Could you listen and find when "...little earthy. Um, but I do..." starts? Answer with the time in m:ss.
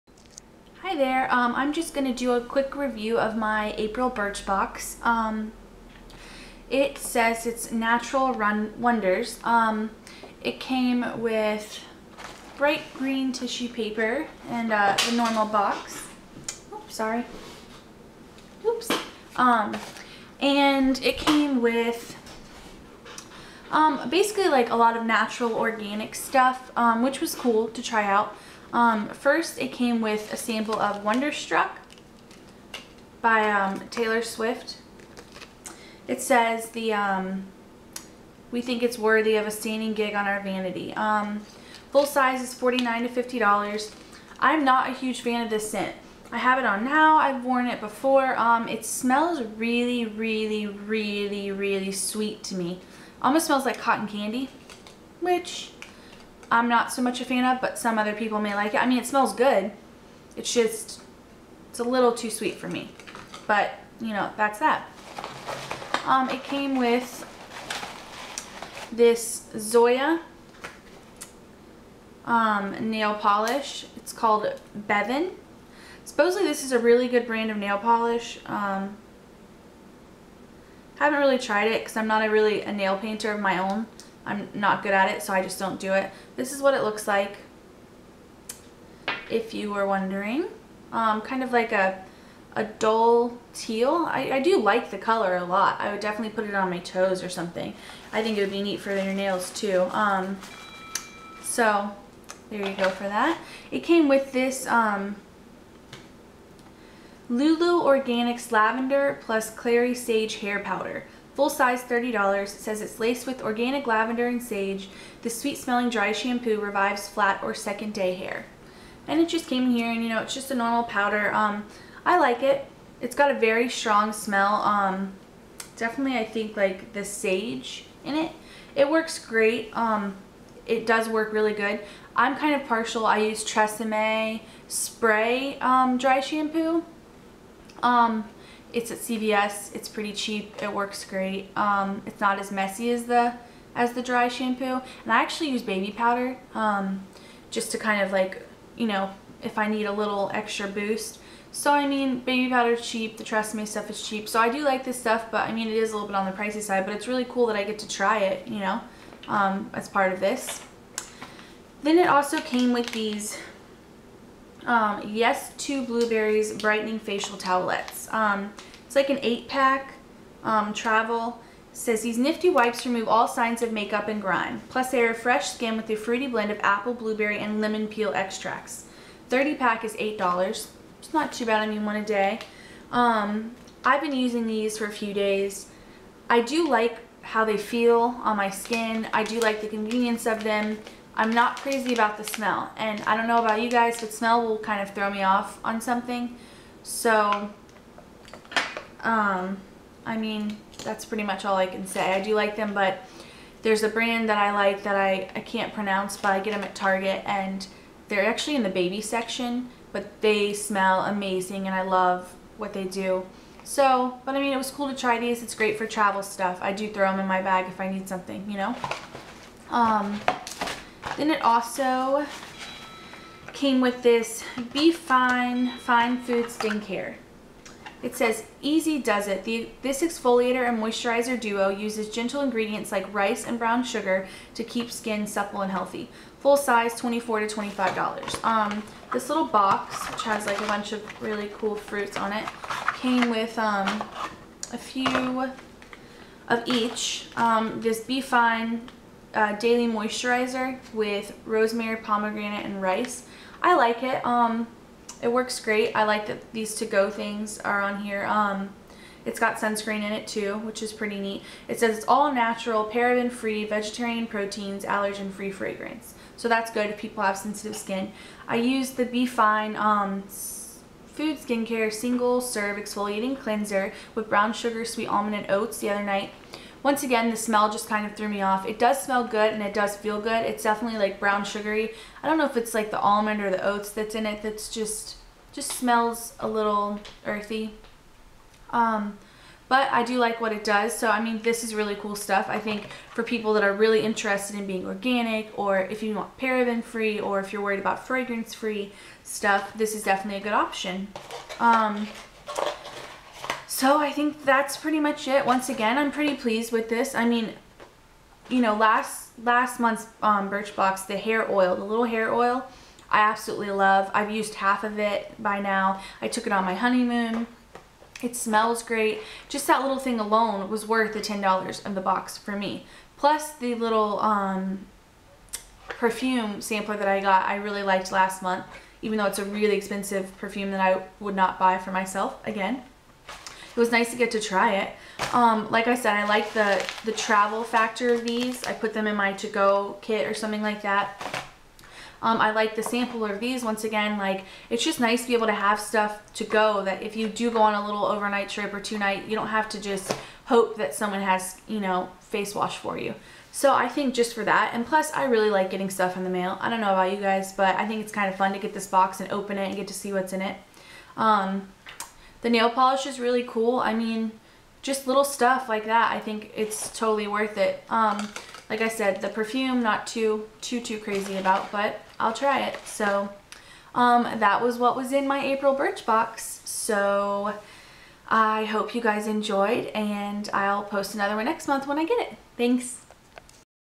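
4:46.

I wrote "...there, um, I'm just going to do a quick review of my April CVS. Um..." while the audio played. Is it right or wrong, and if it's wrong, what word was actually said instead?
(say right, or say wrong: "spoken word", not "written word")
wrong: "Birchbox", not "CVS".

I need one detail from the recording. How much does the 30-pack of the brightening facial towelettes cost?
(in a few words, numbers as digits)
$8.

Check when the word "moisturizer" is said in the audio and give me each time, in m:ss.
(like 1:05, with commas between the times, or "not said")
3:50, 4:09.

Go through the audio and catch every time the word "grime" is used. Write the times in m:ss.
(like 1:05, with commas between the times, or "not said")
2:54.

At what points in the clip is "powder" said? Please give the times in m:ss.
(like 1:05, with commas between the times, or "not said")
1:50, 2:00, 2:25, 2:32.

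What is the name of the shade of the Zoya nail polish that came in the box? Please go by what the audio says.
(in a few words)
Bevin.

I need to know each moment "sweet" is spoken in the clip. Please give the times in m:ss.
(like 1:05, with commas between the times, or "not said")
0:51, 1:02, 1:55, 4:34.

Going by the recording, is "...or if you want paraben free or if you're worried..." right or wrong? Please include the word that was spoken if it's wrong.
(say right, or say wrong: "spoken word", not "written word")
right.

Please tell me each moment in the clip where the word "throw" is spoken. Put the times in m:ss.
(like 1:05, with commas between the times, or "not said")
3:14, 3:36.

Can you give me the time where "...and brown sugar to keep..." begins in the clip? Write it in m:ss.
3:53.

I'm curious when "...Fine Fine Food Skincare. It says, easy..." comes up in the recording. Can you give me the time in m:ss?
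3:44.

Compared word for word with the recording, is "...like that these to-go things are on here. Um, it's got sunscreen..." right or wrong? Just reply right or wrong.
right.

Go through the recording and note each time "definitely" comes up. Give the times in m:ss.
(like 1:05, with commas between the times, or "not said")
1:36, 2:05, 4:40, 5:00.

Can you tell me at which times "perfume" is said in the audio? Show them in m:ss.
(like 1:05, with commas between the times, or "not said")
5:25, 5:30, 6:09.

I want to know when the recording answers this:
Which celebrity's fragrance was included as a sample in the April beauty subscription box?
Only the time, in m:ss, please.
0:33.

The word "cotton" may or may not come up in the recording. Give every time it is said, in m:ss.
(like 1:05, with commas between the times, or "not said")
0:53.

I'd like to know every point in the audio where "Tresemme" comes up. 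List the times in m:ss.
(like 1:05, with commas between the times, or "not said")
2:13, 2:33.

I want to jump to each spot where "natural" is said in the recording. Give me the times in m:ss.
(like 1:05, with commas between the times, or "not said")
0:07, 0:25, 4:22.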